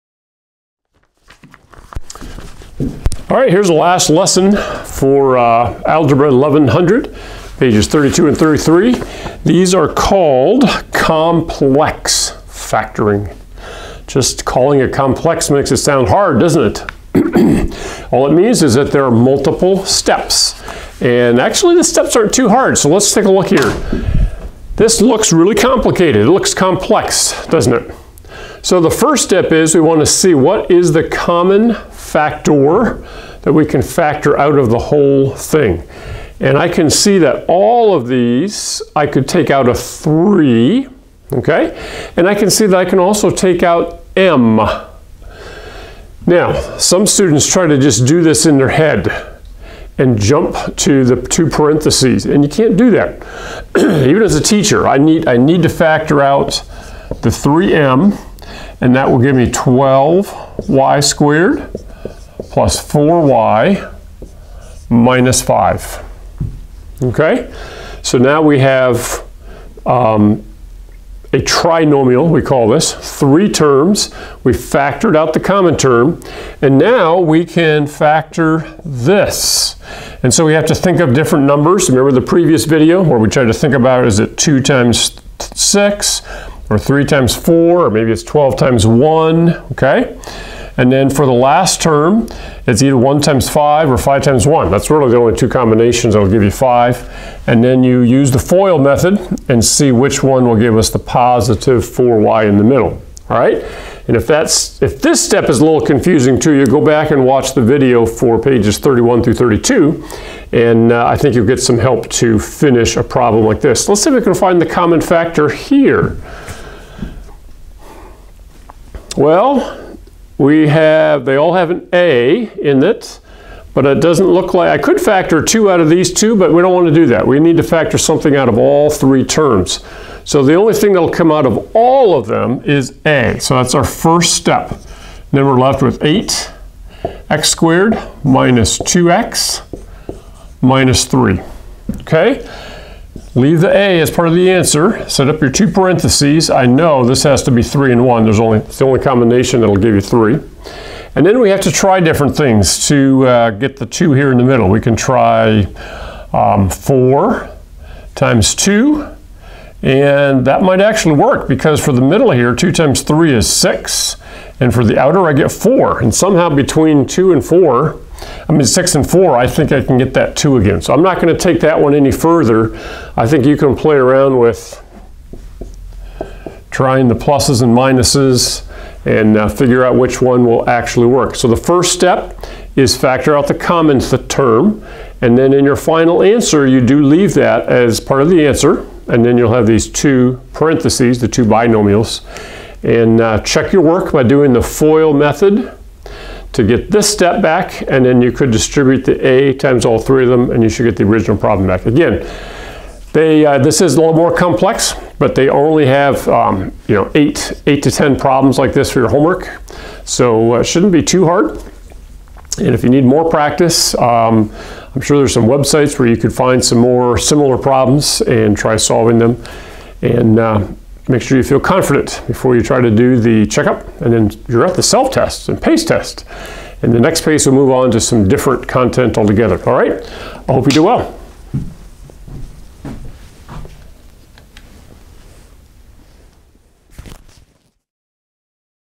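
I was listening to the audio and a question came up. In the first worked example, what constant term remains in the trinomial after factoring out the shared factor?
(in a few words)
minus 5.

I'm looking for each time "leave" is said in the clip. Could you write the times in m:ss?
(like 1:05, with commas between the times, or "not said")
2:23, 3:07.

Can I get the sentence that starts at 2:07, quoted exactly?
We need to factor something out of all three terms.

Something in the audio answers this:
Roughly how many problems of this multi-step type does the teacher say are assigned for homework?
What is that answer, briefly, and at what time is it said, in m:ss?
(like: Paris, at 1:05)
8 to 10, at 3:27.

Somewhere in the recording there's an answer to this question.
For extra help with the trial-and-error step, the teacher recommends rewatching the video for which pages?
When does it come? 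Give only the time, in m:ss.
1:48.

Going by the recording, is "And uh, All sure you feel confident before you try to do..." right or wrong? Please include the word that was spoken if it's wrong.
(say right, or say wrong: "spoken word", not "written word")
wrong: "Make", not "All".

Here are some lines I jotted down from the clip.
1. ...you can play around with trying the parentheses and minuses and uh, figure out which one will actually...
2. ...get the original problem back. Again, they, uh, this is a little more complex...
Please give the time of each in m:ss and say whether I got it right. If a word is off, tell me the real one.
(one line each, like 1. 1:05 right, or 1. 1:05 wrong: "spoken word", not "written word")
1. 2:53 wrong: "pluses", not "parentheses"
2. 3:20 right.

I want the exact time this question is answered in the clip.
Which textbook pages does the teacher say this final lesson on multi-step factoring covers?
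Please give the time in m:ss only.
0:07.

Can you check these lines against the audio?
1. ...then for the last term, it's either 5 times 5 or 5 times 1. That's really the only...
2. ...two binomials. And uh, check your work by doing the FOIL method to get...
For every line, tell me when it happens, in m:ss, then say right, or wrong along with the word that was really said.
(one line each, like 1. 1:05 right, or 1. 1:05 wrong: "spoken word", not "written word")
1. 1:30 wrong: "1", not "5"
2. 3:11 right.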